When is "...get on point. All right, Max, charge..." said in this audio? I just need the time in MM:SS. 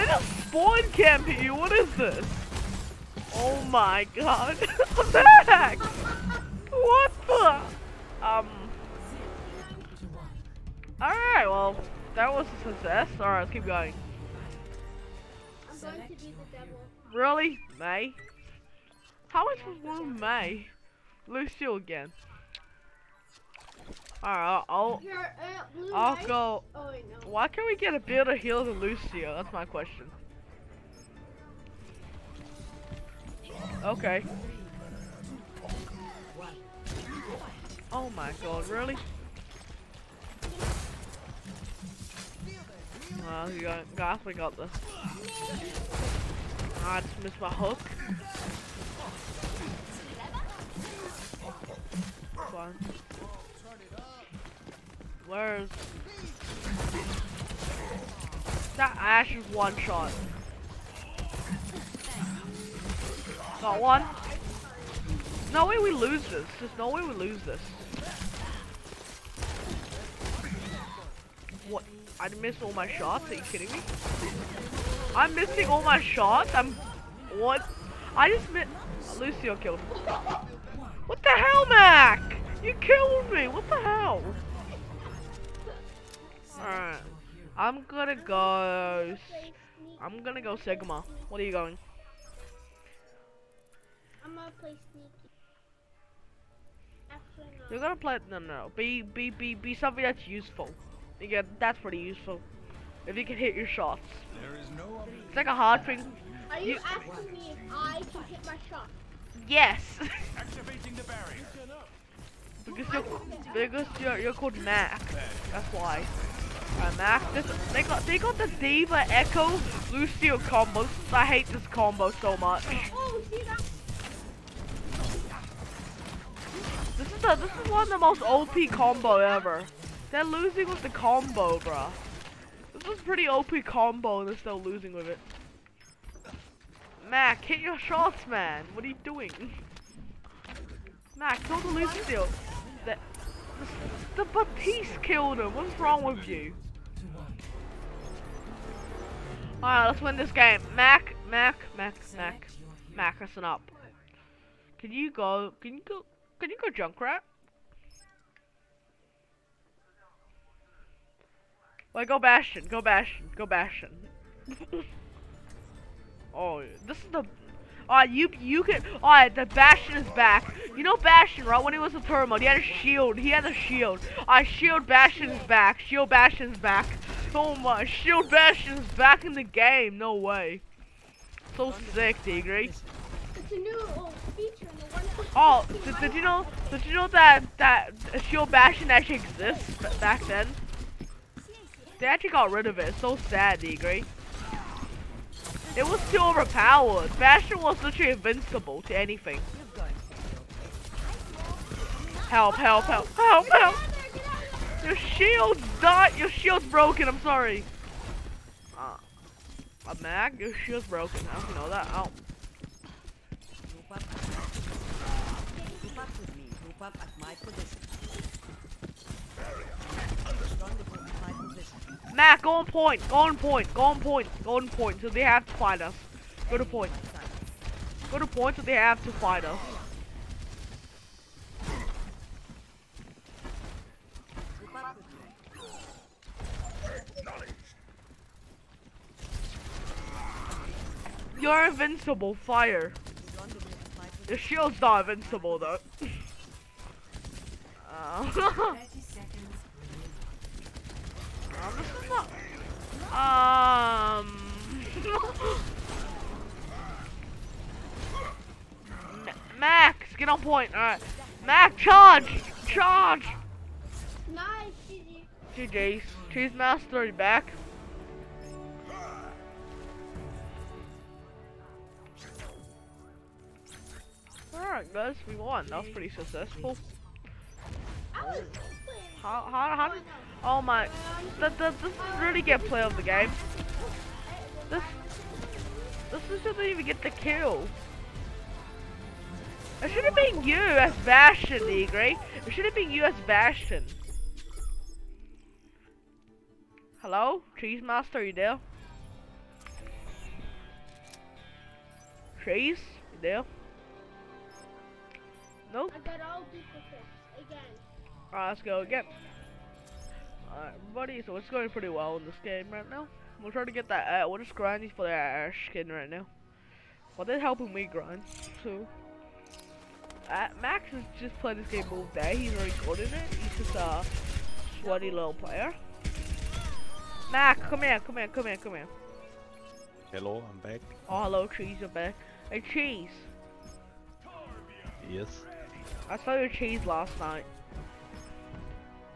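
04:20.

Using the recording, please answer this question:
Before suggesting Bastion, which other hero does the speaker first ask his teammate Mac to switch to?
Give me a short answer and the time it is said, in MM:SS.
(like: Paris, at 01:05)
Junkrat, at 02:36.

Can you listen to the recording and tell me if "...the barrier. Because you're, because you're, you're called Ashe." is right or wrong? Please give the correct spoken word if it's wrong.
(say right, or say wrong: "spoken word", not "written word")
wrong: "Mac", not "Ashe".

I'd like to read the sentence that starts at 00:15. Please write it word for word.
I'm going to be the devil.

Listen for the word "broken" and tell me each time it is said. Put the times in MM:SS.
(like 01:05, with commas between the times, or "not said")
03:26, 03:30.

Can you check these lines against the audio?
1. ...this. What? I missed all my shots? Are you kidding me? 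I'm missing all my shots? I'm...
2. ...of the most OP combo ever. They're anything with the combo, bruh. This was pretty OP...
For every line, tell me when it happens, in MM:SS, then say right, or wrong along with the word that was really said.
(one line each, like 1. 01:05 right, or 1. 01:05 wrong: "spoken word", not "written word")
1. 01:07 right
2. 02:07 wrong: "losing", not "anything".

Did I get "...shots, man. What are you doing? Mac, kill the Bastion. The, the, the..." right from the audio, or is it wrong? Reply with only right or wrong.
wrong.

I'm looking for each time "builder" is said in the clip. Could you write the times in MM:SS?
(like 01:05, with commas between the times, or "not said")
00:27.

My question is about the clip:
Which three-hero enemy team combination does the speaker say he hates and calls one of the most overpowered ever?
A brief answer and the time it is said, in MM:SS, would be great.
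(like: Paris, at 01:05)
D.Va Echo Lucio, at 01:58.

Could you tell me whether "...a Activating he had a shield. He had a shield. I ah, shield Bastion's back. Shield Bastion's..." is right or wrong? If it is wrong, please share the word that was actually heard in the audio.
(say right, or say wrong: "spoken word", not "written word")
wrong: "Pro", not "Activating".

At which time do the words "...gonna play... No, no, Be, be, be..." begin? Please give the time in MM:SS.
01:37.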